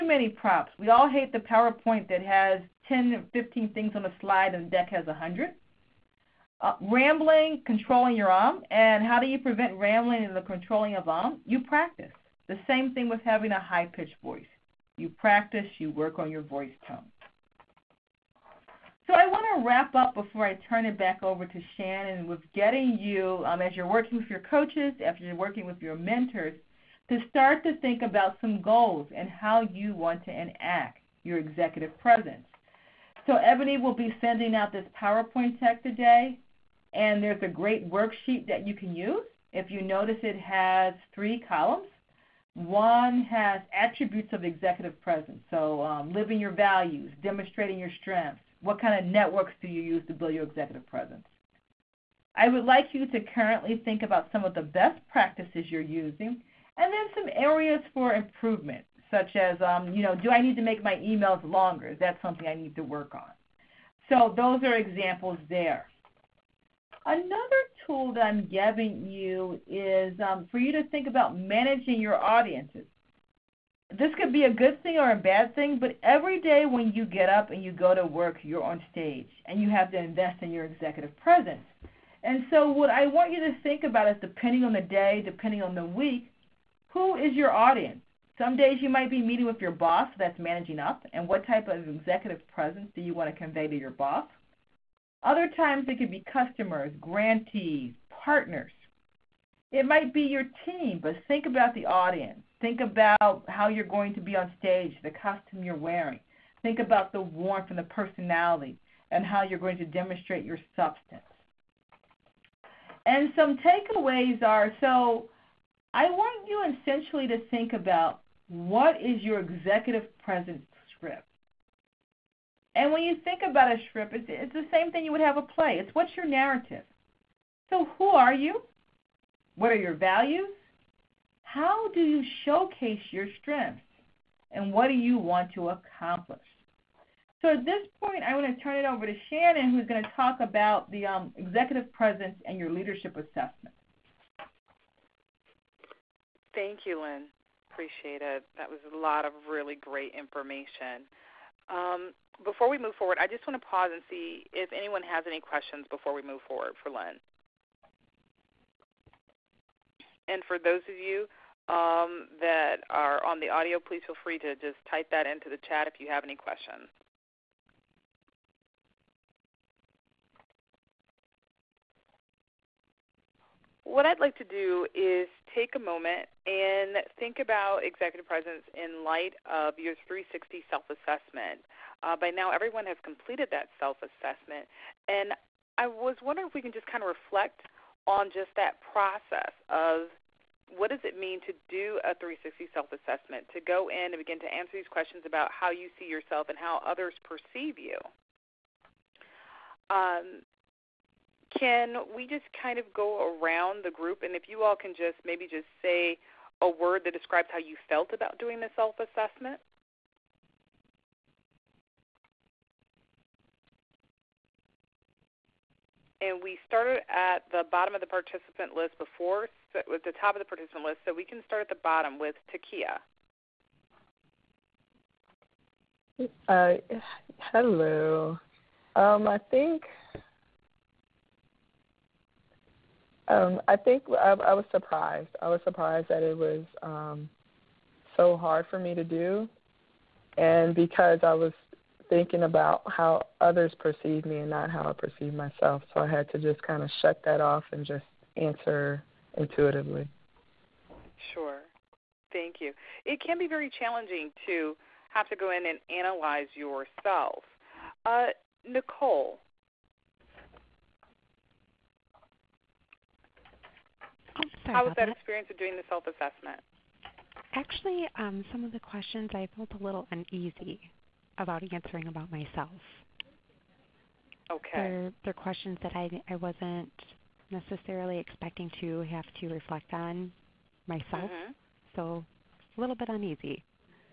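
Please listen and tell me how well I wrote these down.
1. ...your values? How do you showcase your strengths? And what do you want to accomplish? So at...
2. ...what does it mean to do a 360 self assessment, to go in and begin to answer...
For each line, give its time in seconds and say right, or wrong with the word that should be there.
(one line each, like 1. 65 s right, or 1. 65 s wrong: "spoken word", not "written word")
1. 129 s right
2. 190 s right.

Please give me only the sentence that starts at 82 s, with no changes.
And so, what I want you to think about is depending on the day, depending on the week, who is your audience?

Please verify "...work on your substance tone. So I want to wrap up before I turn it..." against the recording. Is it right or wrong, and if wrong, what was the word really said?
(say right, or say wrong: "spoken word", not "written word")
wrong: "voice", not "substance".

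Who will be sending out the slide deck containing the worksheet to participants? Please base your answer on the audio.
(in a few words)
Ebony.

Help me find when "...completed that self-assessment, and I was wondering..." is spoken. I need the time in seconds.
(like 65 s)
183 s.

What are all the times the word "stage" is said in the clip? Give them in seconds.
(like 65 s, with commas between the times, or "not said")
78 s, 104 s.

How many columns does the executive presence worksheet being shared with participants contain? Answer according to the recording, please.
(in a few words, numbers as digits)
3.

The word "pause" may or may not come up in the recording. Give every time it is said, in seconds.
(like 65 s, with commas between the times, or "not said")
153 s.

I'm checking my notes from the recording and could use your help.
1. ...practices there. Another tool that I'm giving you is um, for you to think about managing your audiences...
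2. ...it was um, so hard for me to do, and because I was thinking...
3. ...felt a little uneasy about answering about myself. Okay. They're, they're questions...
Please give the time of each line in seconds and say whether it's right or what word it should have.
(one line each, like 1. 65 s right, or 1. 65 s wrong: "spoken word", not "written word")
1. 64 s wrong: "examples", not "practices"
2. 236 s right
3. 269 s right.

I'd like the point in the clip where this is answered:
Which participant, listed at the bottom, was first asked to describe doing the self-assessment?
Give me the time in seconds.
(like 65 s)
222 s.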